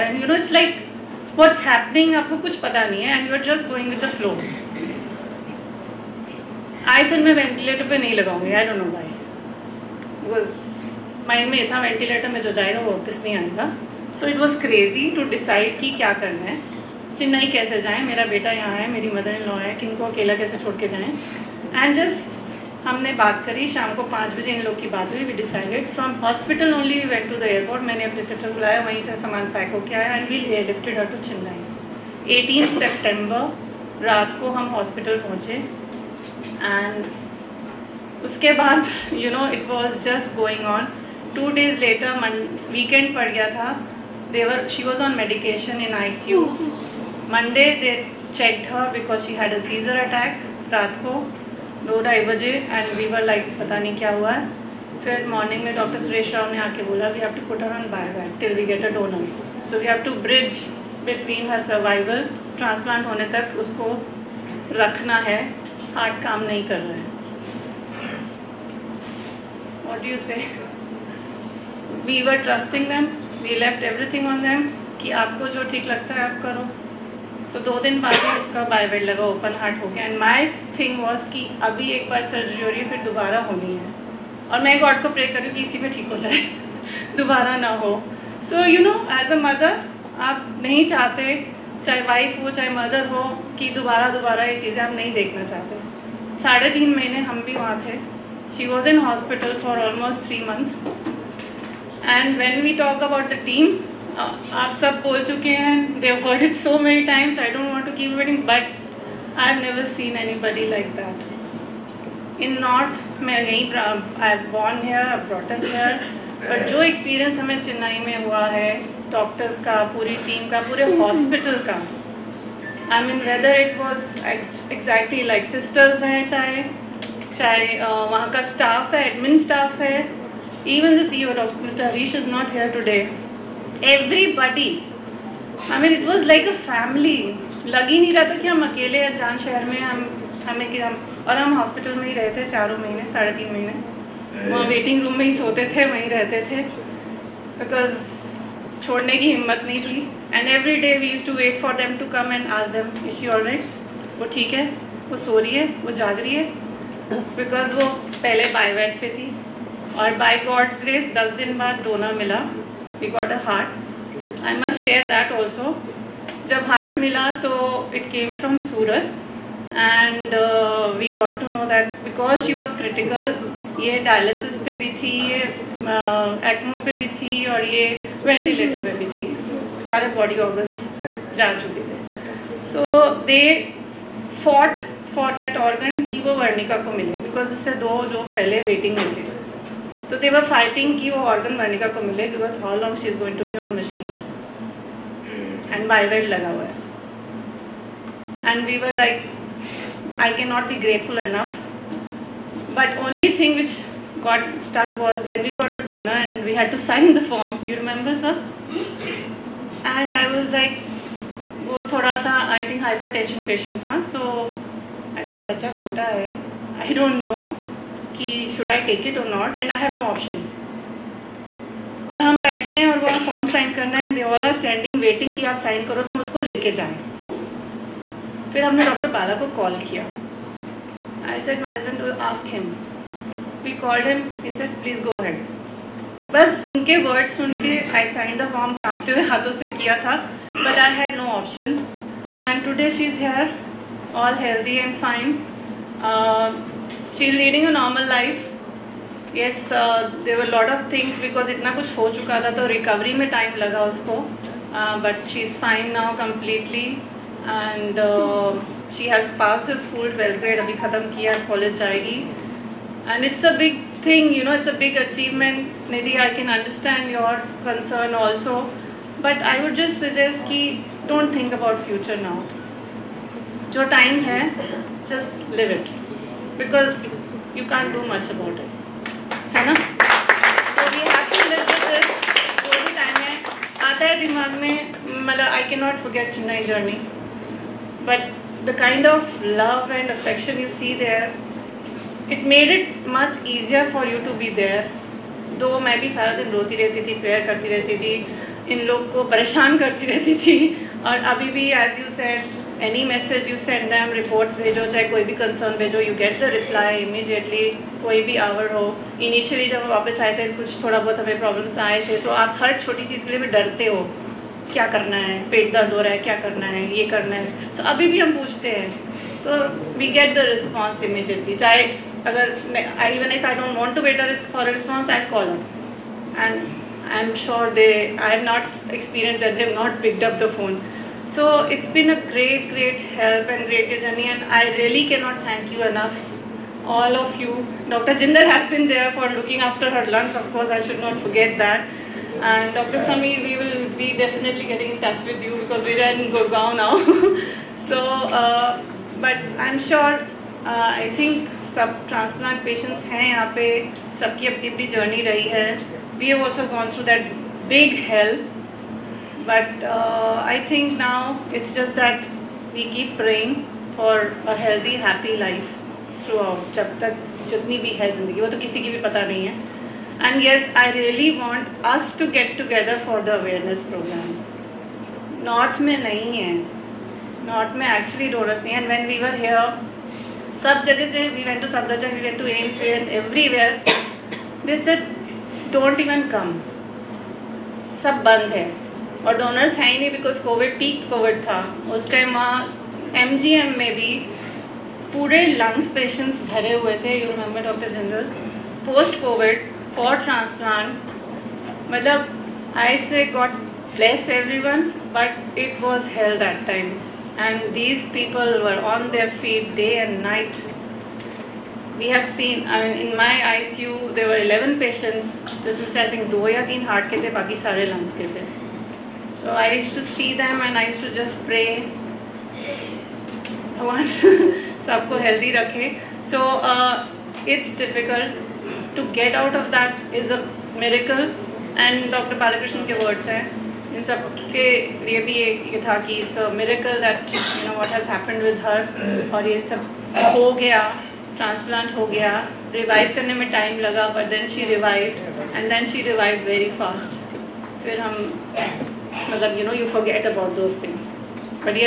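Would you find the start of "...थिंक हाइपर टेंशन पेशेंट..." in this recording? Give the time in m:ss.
3:32.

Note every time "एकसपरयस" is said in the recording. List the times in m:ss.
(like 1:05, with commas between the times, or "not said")
1:56, 5:28.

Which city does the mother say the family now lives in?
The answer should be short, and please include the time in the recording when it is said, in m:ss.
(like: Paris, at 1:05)
Gurgaon, at 5:46.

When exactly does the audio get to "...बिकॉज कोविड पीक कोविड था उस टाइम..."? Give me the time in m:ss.
6:30.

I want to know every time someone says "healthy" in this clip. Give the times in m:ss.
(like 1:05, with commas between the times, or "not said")
6:04.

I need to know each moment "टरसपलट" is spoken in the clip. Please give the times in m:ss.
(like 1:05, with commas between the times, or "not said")
1:02, 6:40, 7:21.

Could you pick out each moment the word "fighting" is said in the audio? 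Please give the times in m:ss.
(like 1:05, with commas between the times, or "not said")
3:10.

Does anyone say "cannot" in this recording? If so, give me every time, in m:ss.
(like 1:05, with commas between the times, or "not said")
3:20, 4:45, 5:35.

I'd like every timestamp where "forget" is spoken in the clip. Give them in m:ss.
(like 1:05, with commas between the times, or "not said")
4:46, 5:41.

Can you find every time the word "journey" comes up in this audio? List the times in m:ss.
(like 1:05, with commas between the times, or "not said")
4:46, 5:34.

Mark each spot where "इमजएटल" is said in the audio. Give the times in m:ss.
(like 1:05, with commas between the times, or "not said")
5:07, 5:21.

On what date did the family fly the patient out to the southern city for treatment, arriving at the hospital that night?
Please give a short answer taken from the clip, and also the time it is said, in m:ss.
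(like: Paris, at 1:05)
18 September, at 0:32.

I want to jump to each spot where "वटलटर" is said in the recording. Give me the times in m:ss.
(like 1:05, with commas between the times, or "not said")
0:07, 0:11, 2:58.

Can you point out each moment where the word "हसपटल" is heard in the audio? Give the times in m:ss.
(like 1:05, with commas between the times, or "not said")
0:26, 0:34, 1:39, 2:00, 2:21.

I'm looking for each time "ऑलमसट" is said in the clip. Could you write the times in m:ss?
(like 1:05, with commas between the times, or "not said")
1:39.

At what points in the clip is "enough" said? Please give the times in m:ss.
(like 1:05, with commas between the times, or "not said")
3:21, 5:35.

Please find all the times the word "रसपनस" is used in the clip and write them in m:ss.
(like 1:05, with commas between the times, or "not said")
5:20, 5:24.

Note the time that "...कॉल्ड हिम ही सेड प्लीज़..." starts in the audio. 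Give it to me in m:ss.
3:53.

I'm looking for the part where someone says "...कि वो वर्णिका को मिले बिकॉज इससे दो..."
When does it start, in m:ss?
3:06.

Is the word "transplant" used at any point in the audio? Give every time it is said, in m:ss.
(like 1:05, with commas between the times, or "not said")
5:52.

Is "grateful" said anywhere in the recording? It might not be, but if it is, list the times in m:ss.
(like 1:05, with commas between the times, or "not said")
3:20.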